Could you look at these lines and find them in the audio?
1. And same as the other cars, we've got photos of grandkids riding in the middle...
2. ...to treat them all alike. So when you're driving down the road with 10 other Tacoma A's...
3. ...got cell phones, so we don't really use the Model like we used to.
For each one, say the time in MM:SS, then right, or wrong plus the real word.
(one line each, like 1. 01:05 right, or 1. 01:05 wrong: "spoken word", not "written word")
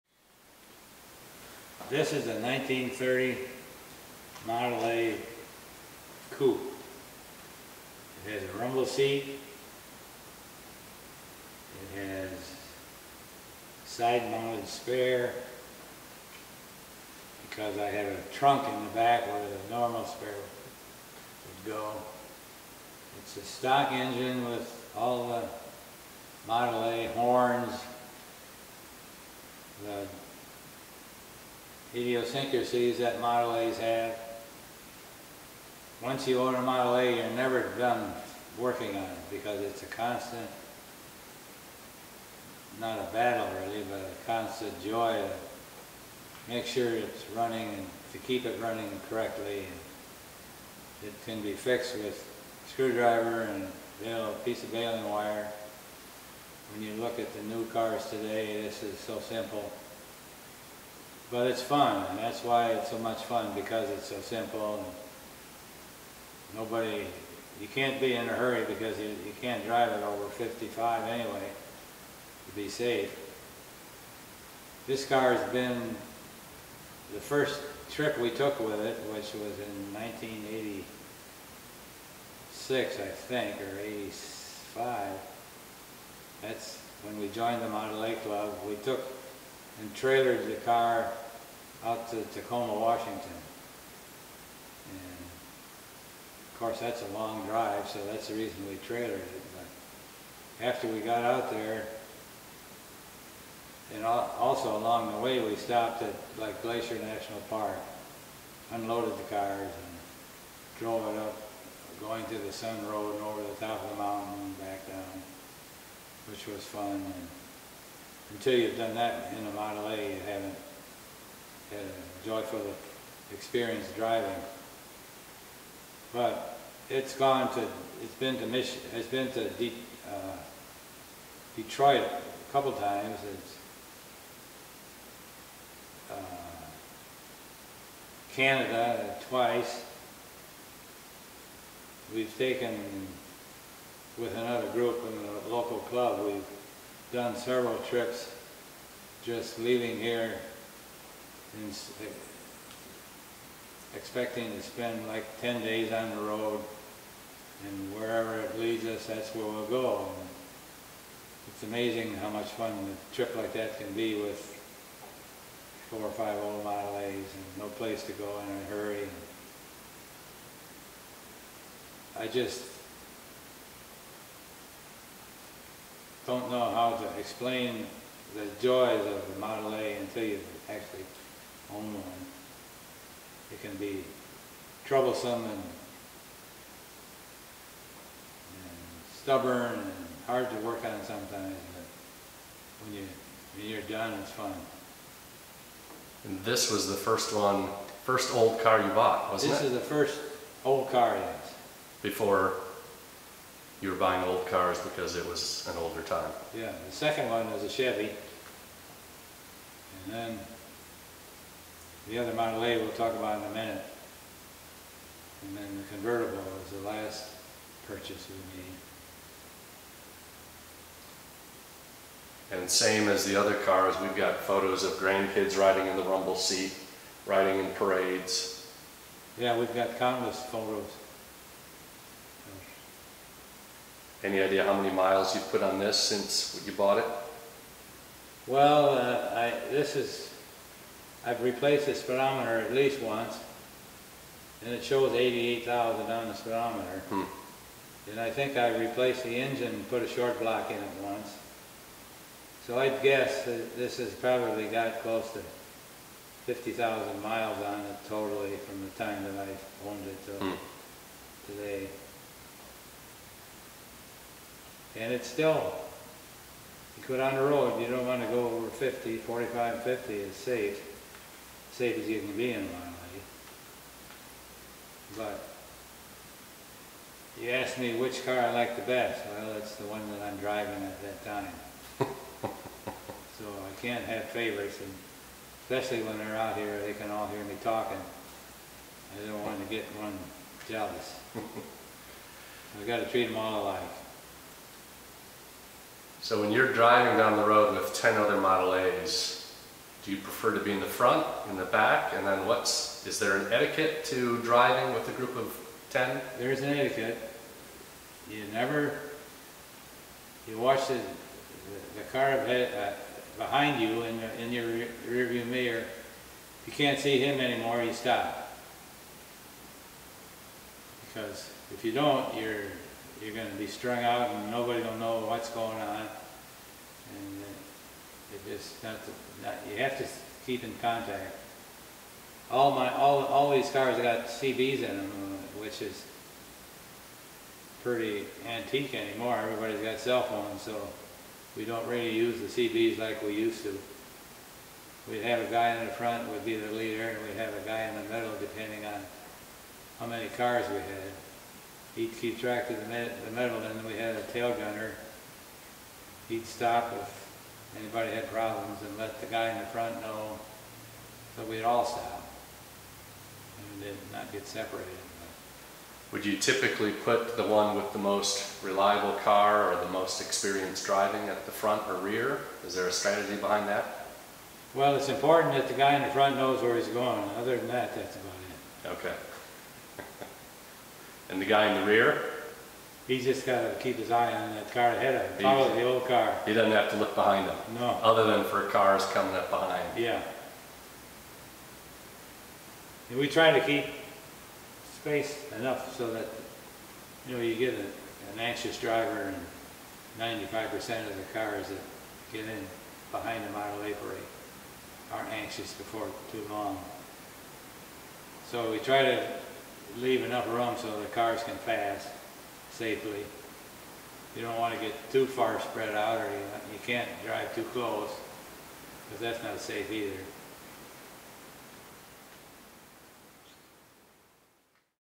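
1. 03:42 wrong: "rumble", not "middle"
2. 04:52 wrong: "Model", not "Tacoma"
3. 05:39 wrong: "CBs", not "Model".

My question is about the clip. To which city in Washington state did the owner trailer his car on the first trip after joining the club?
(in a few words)
Tacoma.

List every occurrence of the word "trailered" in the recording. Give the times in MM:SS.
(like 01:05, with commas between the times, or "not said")
01:29, 01:38.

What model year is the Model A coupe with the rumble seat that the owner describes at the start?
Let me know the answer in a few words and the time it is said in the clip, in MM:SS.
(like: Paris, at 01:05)
1930, at 00:02.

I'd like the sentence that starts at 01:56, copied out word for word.
And, until you've done that in the Model A, you haven't had a joyful experience driving.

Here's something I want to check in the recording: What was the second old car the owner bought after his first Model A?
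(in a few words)
A Chevy.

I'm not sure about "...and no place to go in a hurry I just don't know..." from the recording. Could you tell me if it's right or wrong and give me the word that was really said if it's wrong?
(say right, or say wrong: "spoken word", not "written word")
right.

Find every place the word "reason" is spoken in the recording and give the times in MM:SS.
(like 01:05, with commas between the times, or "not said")
01:38.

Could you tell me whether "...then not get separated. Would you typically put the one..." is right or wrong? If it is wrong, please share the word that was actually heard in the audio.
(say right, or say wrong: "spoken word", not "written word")
right.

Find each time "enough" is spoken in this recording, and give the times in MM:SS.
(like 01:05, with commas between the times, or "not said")
06:35, 06:50.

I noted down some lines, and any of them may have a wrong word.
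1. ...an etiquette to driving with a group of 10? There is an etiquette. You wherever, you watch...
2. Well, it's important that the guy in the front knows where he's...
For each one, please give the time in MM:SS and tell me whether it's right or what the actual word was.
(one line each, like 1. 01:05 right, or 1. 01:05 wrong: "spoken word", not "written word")
1. 05:03 wrong: "never", not "wherever"
2. 06:14 right.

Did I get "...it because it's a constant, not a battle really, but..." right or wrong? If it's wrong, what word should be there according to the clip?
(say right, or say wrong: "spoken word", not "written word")
right.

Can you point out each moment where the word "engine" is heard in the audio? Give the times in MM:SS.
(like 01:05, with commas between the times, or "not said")
00:23, 04:09.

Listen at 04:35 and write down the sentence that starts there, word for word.
But you asked me which car I like the best.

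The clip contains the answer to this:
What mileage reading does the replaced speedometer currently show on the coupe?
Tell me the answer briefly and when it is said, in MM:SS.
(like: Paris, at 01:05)
88,000, at 04:05.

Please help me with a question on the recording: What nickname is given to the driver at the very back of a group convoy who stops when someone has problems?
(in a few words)
Tail gunner.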